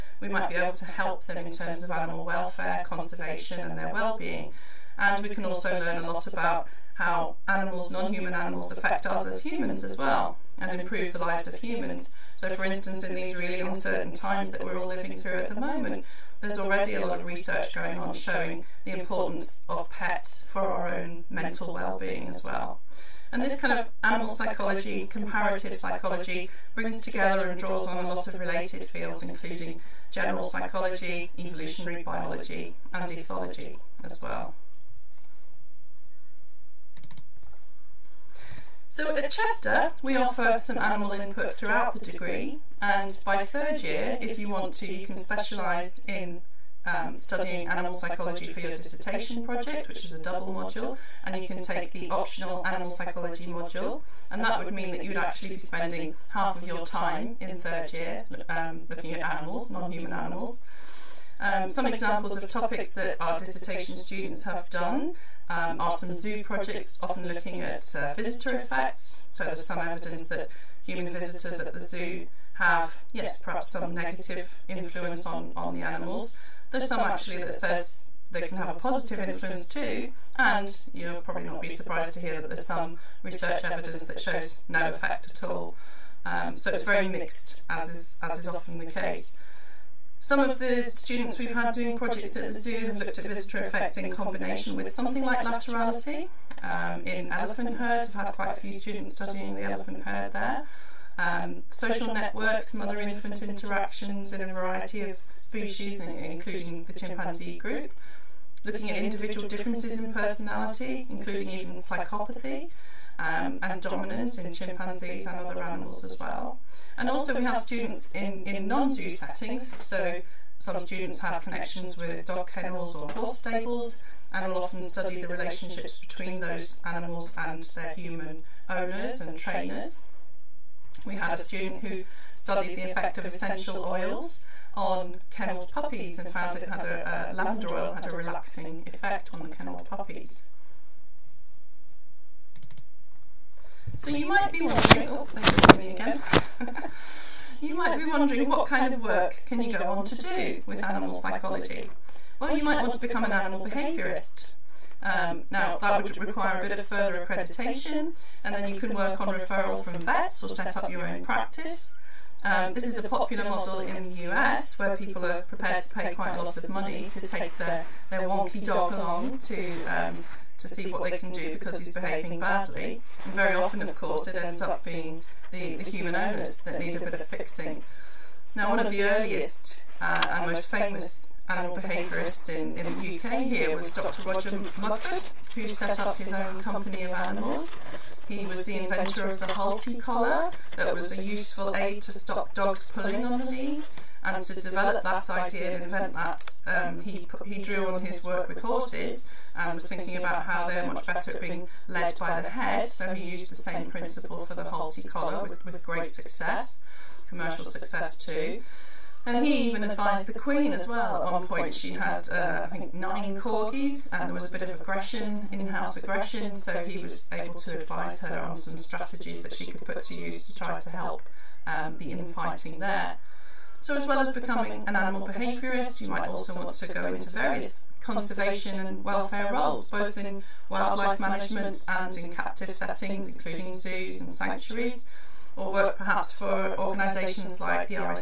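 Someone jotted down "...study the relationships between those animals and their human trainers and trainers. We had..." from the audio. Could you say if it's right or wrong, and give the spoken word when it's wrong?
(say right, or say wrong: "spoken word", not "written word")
wrong: "owners", not "trainers".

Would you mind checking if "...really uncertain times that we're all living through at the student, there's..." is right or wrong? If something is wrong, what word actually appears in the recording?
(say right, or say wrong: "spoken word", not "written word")
wrong: "moment", not "student".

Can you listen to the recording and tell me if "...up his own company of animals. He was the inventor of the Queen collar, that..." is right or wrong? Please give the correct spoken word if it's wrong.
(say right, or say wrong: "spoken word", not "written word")
wrong: "Halti", not "Queen".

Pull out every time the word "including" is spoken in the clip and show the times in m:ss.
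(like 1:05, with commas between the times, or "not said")
0:29, 1:45, 1:51, 3:53.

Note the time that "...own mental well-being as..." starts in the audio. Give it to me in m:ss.
0:20.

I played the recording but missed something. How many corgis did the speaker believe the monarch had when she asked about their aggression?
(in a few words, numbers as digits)
9.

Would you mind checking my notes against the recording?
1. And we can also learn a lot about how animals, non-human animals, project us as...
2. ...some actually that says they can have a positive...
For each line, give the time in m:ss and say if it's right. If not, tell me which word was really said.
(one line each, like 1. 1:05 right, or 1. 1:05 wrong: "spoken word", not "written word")
1. 0:04 wrong: "affect", not "project"
2. 1:16 right.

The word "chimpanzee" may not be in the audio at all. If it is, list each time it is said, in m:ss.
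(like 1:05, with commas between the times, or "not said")
1:46, 1:54.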